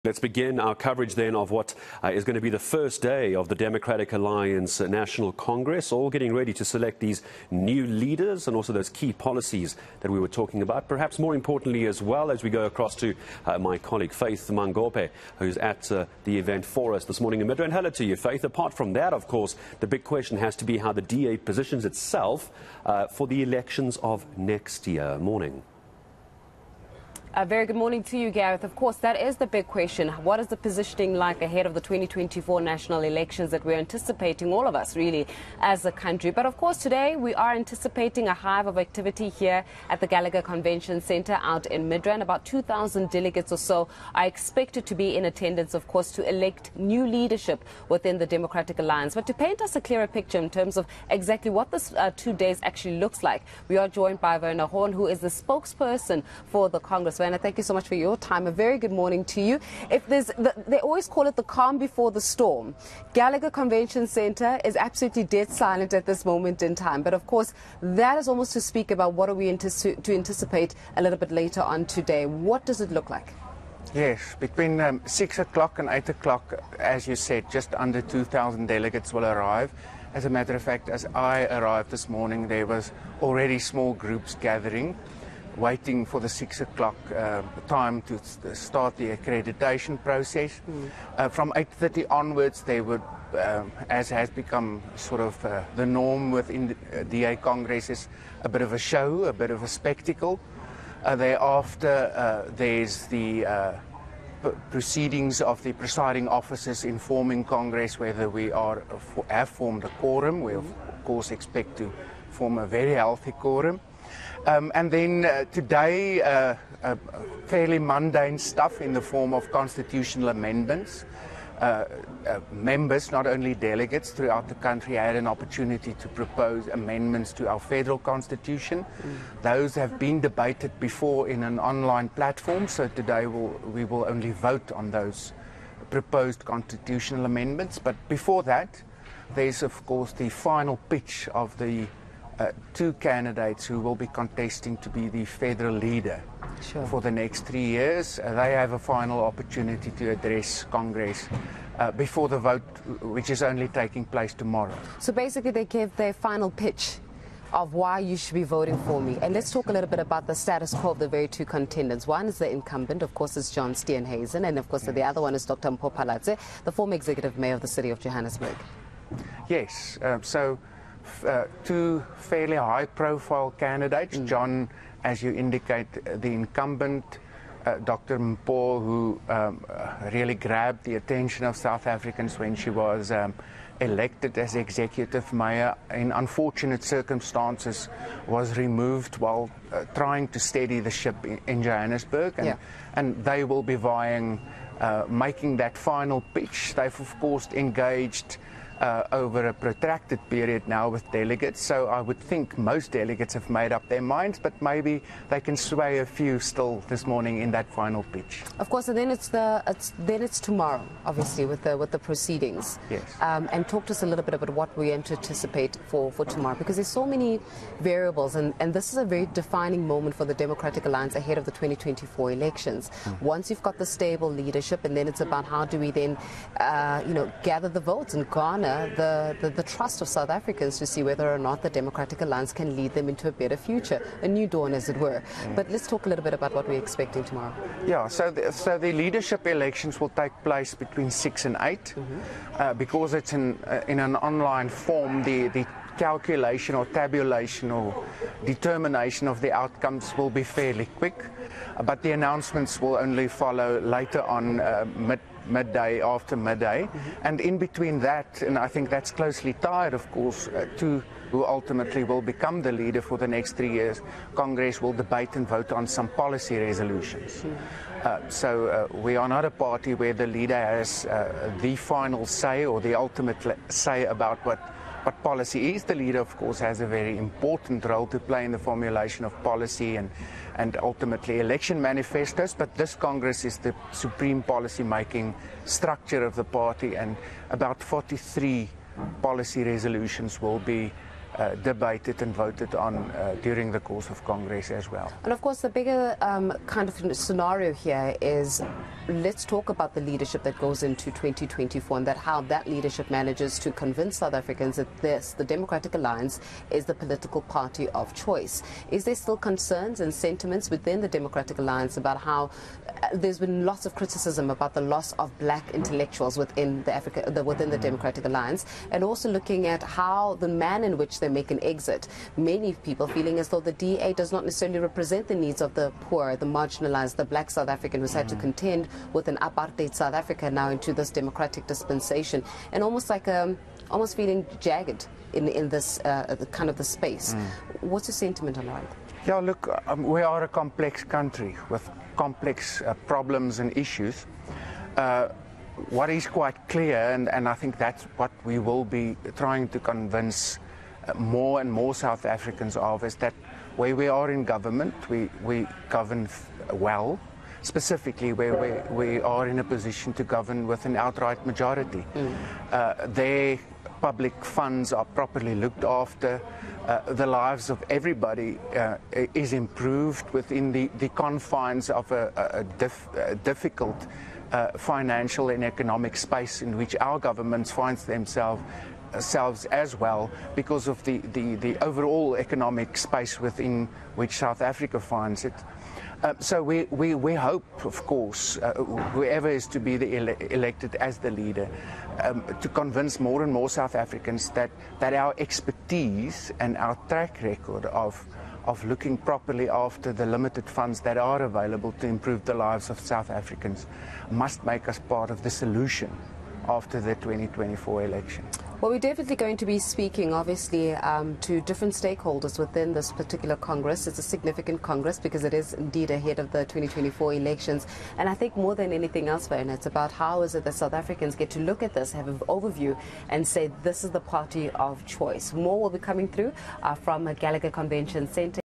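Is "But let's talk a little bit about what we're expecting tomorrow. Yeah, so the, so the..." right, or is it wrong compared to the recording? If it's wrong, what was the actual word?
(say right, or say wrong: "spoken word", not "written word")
right.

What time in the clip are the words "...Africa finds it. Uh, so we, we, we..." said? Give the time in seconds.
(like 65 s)
384 s.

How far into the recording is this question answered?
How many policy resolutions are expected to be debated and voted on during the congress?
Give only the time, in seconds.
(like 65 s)
287 s.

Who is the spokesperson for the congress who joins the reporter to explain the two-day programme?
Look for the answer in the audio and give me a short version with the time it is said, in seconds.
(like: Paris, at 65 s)
Werner Horn, at 54 s.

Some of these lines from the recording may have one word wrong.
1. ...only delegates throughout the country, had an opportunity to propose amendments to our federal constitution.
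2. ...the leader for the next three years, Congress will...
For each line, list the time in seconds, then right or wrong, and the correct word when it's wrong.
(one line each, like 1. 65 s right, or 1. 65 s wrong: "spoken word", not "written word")
1. 123 s right
2. 262 s right.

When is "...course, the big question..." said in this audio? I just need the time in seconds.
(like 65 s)
19 s.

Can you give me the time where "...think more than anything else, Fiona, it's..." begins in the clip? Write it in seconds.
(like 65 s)
418 s.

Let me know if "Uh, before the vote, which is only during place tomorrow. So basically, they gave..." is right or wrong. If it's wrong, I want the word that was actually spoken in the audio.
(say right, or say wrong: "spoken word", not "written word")
wrong: "taking", not "during".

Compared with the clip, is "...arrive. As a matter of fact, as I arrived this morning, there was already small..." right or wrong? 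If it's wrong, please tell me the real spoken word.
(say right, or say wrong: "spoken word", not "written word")
right.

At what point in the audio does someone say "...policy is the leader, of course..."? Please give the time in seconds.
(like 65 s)
275 s.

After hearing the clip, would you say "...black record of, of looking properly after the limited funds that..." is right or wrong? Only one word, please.
wrong.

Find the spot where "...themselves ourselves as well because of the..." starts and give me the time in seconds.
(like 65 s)
378 s.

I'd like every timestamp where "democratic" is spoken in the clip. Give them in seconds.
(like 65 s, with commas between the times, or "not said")
3 s, 48 s, 220 s, 231 s, 305 s, 311 s, 317 s, 331 s.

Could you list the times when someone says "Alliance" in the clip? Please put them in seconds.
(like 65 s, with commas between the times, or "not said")
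4 s, 48 s, 220 s, 232 s, 305 s, 311 s, 318 s.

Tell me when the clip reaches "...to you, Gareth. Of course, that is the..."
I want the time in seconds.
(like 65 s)
28 s.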